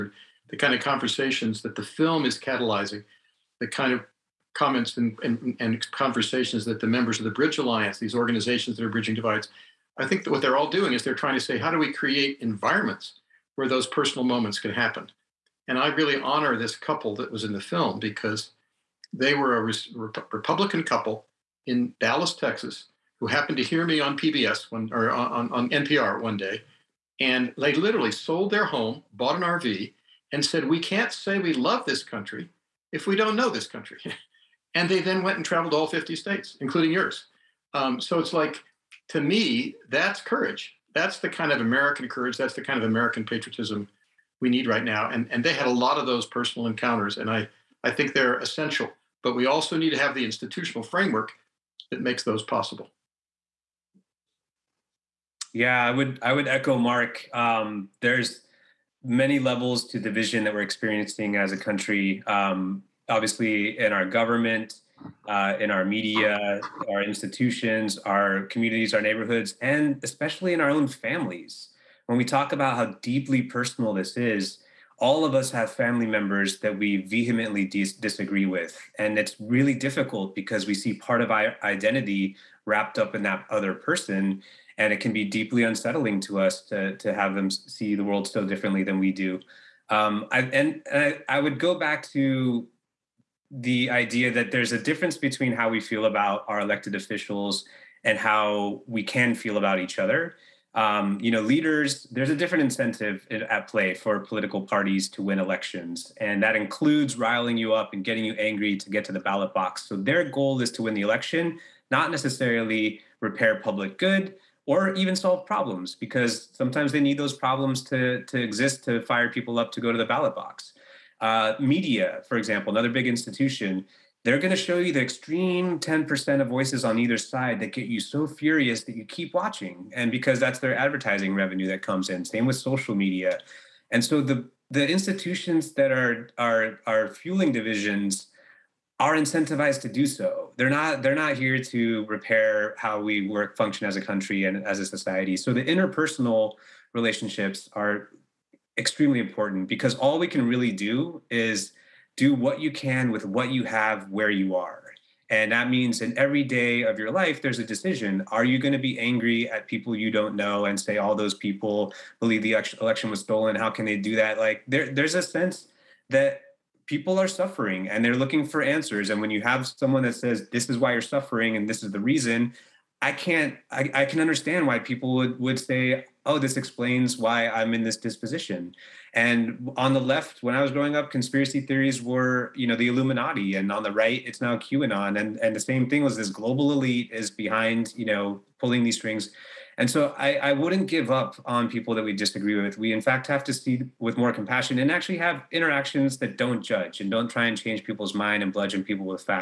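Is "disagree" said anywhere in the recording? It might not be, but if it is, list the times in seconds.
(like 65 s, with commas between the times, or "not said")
77 s, 192 s.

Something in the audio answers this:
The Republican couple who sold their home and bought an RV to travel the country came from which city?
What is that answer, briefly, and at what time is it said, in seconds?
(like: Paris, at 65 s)
Dallas, Texas, at 22 s.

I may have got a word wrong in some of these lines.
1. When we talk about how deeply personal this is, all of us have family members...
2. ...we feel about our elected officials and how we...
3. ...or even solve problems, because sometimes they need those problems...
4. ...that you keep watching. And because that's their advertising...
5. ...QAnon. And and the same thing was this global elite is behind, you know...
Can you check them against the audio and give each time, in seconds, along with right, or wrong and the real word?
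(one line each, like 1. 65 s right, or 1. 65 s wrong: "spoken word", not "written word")
1. 72 s right
2. 95 s right
3. 114 s right
4. 128 s right
5. 184 s right.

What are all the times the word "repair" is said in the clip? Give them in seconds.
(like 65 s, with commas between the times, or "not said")
113 s, 142 s.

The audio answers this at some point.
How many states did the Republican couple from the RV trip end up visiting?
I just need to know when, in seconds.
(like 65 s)
35 s.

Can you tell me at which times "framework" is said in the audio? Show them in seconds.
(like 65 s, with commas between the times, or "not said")
50 s.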